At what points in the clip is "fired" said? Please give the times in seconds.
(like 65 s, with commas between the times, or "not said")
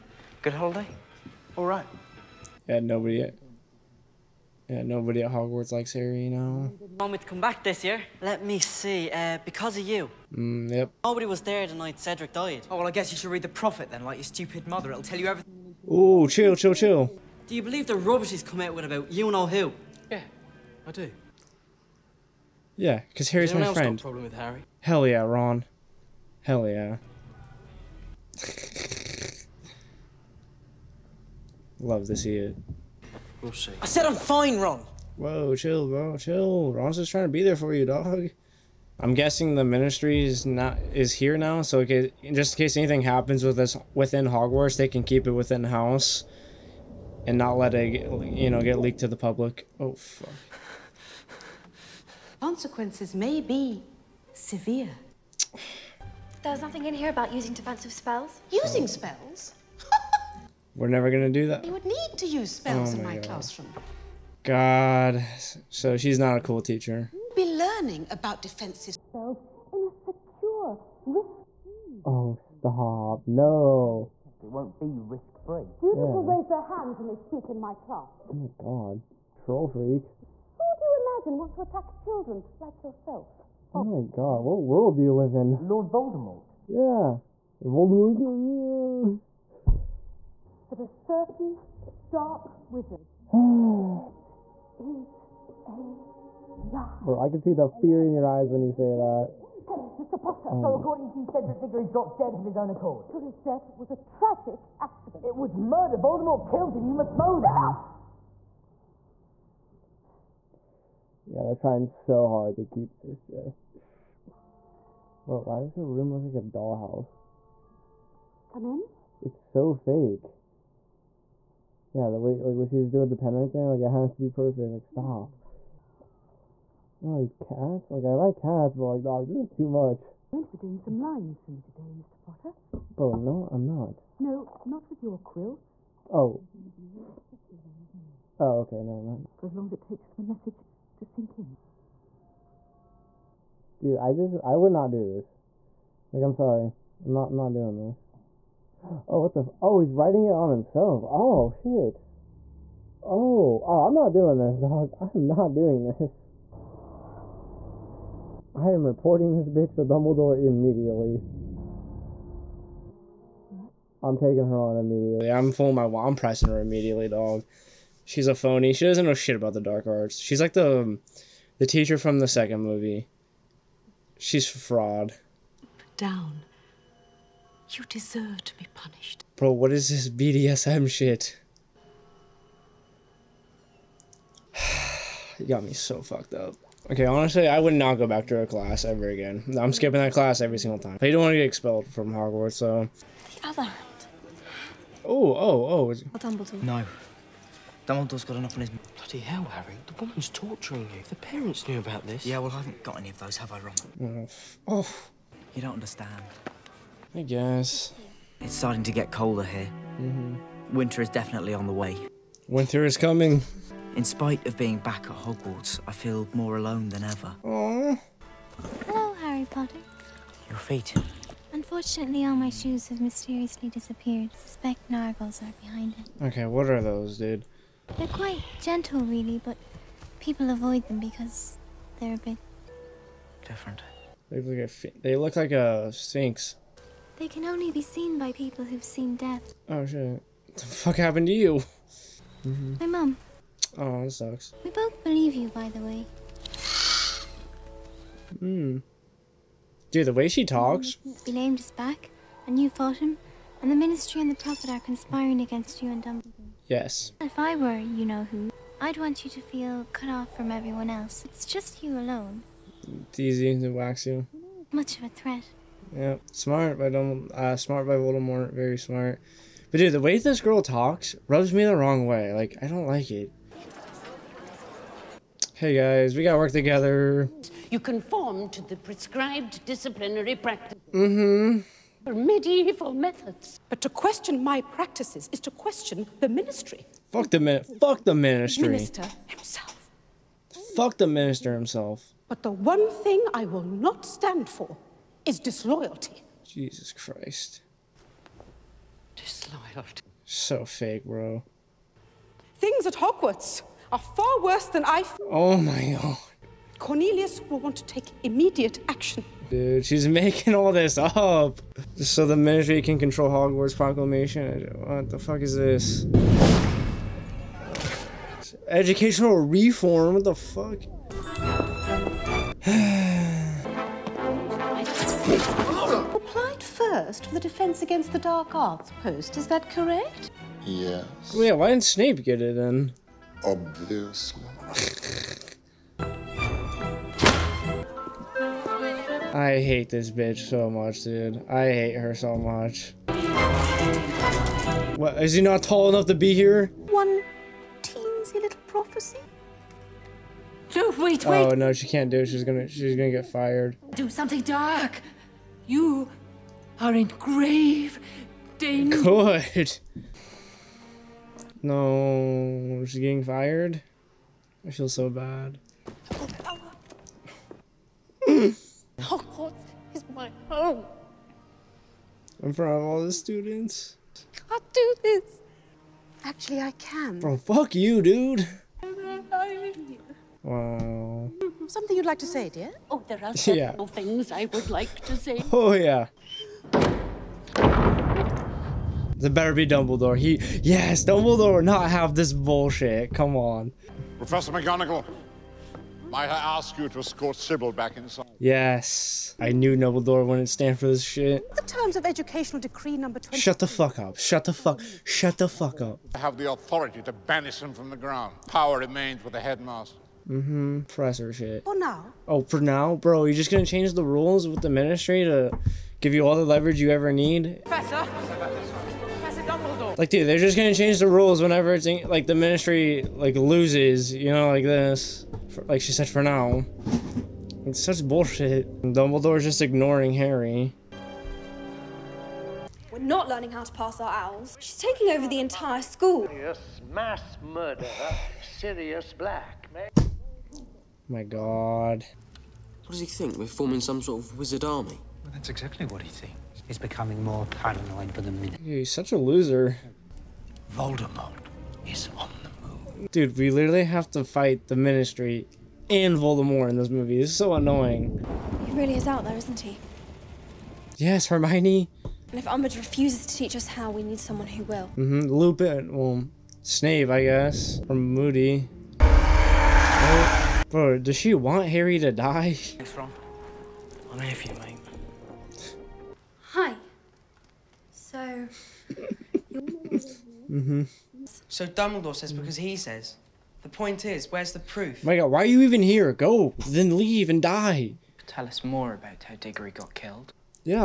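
353 s, 363 s.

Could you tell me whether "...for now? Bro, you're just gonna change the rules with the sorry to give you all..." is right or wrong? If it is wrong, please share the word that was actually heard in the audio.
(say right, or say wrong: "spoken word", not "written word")
wrong: "ministry", not "sorry".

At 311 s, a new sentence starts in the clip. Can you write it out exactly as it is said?
So the ministry can control Hogwarts proclamation.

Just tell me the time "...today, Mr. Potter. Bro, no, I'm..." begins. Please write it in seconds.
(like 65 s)
131 s.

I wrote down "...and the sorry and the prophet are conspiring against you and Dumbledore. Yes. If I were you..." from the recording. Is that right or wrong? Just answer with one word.
wrong.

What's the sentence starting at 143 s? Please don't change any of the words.
Dude, I just I would not do this.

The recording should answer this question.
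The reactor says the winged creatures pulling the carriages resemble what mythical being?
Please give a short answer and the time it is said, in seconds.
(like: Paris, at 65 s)
A sphinx, at 235 s.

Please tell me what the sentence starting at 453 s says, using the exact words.
Dude, we literally have to fight the Ministry and Voldemort in this movie.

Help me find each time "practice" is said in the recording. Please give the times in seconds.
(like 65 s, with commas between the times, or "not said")
280 s, 284 s.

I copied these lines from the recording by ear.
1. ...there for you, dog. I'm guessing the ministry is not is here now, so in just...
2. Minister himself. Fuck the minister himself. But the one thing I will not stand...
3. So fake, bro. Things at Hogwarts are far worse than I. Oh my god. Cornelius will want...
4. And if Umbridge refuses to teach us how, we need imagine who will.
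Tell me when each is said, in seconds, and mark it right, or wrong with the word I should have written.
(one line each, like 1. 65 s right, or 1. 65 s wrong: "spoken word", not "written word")
1. 37 s right
2. 288 s right
3. 300 s right
4. 462 s wrong: "someone", not "imagine".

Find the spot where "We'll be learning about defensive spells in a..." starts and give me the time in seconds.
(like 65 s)
67 s.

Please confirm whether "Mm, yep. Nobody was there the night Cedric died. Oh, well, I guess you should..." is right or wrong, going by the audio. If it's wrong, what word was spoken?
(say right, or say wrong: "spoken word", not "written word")
right.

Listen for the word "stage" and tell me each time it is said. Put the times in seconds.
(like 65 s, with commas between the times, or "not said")
not said.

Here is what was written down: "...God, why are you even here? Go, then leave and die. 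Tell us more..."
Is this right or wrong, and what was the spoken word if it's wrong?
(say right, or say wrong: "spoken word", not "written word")
right.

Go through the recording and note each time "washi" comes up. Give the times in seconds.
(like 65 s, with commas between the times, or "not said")
not said.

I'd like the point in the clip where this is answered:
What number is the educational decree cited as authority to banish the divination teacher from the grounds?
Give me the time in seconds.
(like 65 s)
402 s.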